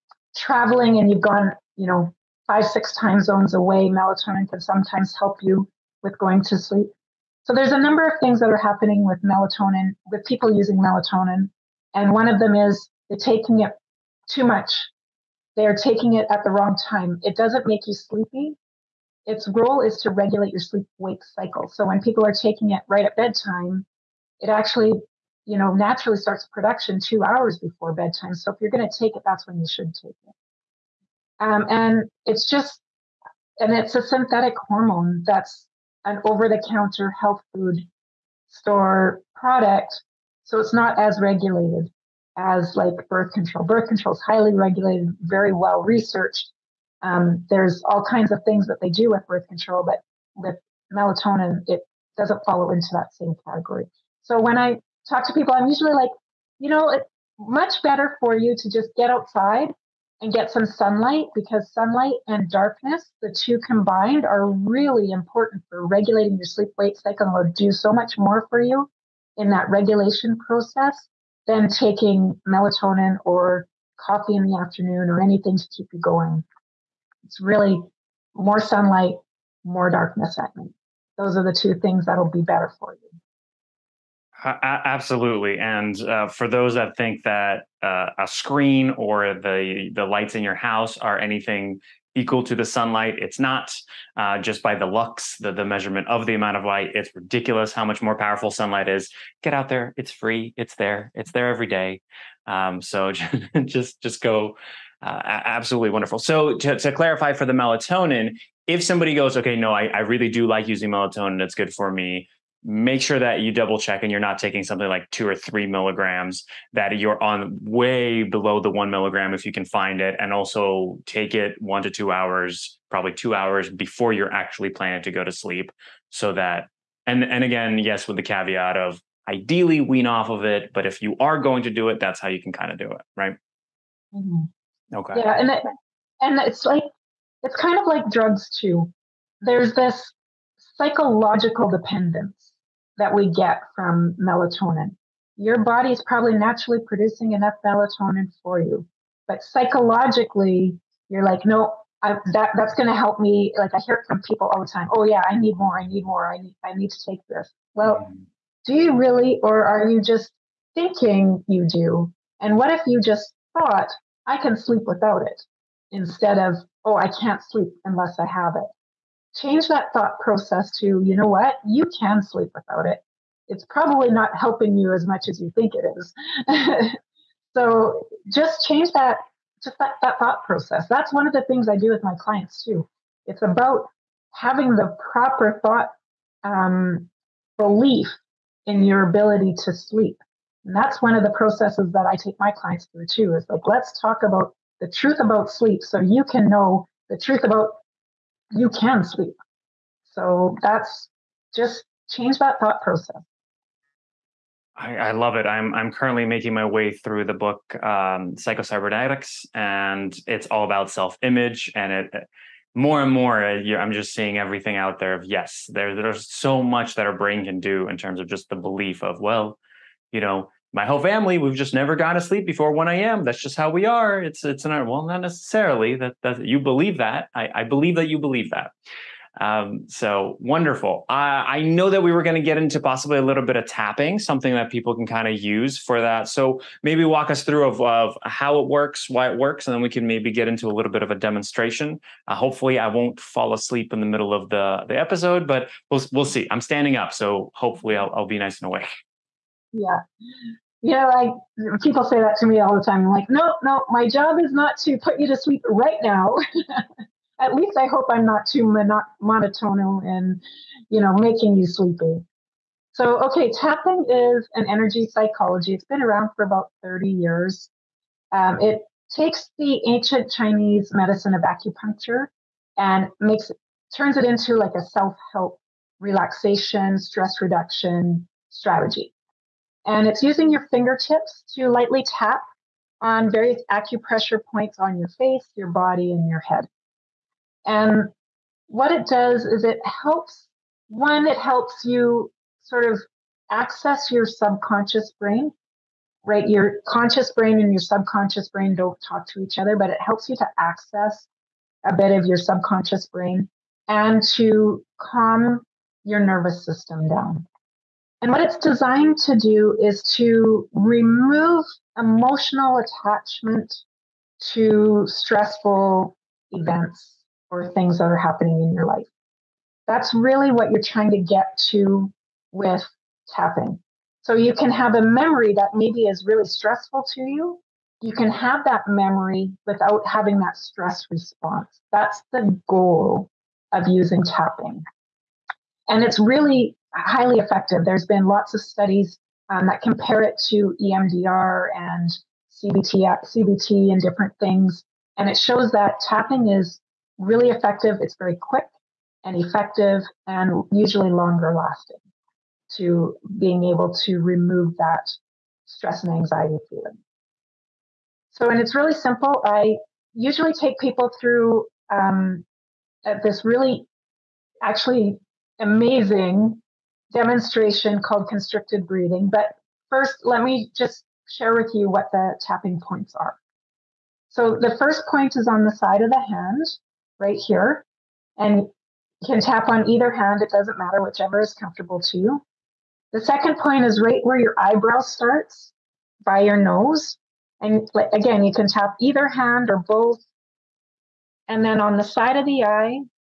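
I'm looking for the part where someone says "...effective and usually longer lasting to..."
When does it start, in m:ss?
5:49.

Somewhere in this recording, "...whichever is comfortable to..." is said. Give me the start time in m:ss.
6:21.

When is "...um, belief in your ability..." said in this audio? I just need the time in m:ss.
3:06.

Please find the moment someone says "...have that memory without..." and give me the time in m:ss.
5:28.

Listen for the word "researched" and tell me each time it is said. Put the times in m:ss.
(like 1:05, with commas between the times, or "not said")
0:45.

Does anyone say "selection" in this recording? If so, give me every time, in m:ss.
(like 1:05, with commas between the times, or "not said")
not said.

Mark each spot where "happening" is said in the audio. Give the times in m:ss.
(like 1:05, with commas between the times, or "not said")
0:08, 5:18.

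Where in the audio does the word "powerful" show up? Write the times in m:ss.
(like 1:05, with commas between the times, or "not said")
1:38.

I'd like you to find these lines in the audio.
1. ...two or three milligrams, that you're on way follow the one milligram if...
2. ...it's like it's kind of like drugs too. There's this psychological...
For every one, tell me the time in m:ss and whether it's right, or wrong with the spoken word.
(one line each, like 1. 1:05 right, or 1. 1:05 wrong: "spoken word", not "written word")
1. 1:55 wrong: "below", not "follow"
2. 2:16 right.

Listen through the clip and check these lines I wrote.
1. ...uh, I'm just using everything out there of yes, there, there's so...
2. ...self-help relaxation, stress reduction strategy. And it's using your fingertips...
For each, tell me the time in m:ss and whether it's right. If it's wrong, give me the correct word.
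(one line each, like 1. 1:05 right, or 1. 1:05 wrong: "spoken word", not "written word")
1. 3:33 wrong: "seeing", not "using"
2. 4:34 right.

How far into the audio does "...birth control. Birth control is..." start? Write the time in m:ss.
0:43.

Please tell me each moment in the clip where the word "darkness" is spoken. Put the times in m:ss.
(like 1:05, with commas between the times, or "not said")
1:02, 1:19.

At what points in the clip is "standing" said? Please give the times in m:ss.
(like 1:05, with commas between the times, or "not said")
4:06.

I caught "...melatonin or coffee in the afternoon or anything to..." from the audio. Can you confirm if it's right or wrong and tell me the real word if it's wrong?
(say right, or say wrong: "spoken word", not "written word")
right.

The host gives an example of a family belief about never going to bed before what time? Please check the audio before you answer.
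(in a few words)
1 a.m.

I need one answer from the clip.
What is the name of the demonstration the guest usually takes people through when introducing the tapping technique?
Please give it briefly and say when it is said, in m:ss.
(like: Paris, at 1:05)
Constricted breathing, at 6:08.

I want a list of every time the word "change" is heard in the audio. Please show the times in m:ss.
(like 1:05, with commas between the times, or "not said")
2:49, 2:58, 3:22.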